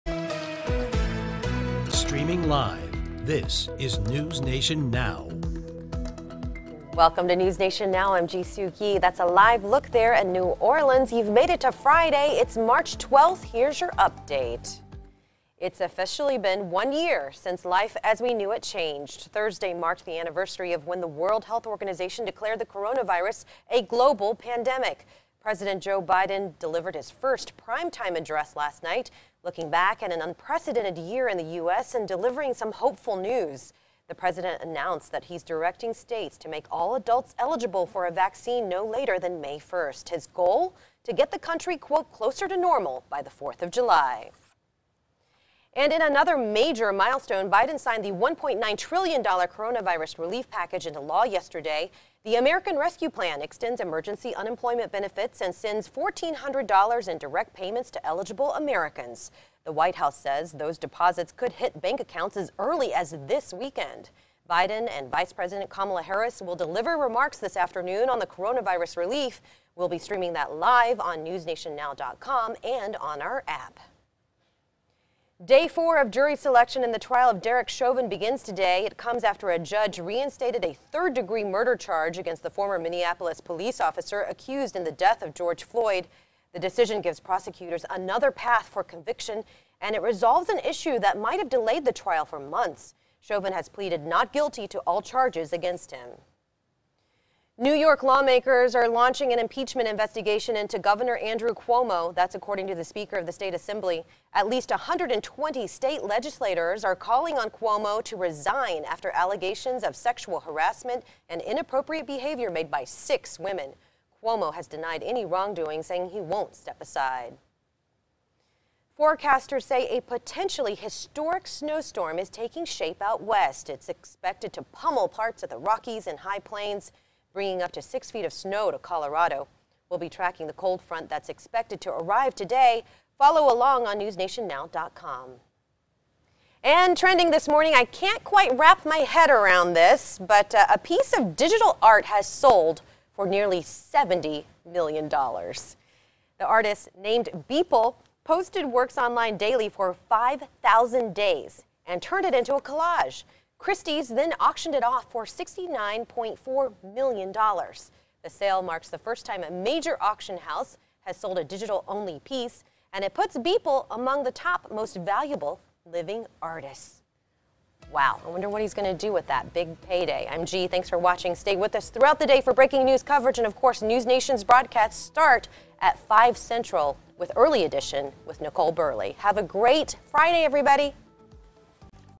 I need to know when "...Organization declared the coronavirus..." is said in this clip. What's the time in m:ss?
0:21.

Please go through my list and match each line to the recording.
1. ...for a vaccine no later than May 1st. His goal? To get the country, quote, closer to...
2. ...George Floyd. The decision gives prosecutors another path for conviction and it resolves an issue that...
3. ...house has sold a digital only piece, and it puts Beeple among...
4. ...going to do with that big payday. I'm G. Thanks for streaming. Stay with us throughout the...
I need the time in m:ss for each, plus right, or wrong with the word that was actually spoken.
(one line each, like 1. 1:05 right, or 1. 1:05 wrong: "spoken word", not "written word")
1. 0:37 right
2. 1:25 right
3. 2:40 right
4. 2:48 wrong: "watching", not "streaming".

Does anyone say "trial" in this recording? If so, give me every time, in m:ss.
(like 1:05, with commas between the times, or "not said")
1:16, 1:31.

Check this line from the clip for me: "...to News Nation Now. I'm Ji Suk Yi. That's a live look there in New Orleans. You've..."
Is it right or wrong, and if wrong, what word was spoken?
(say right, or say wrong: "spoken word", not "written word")
right.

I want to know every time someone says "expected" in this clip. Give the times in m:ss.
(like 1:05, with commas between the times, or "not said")
2:03, 2:11.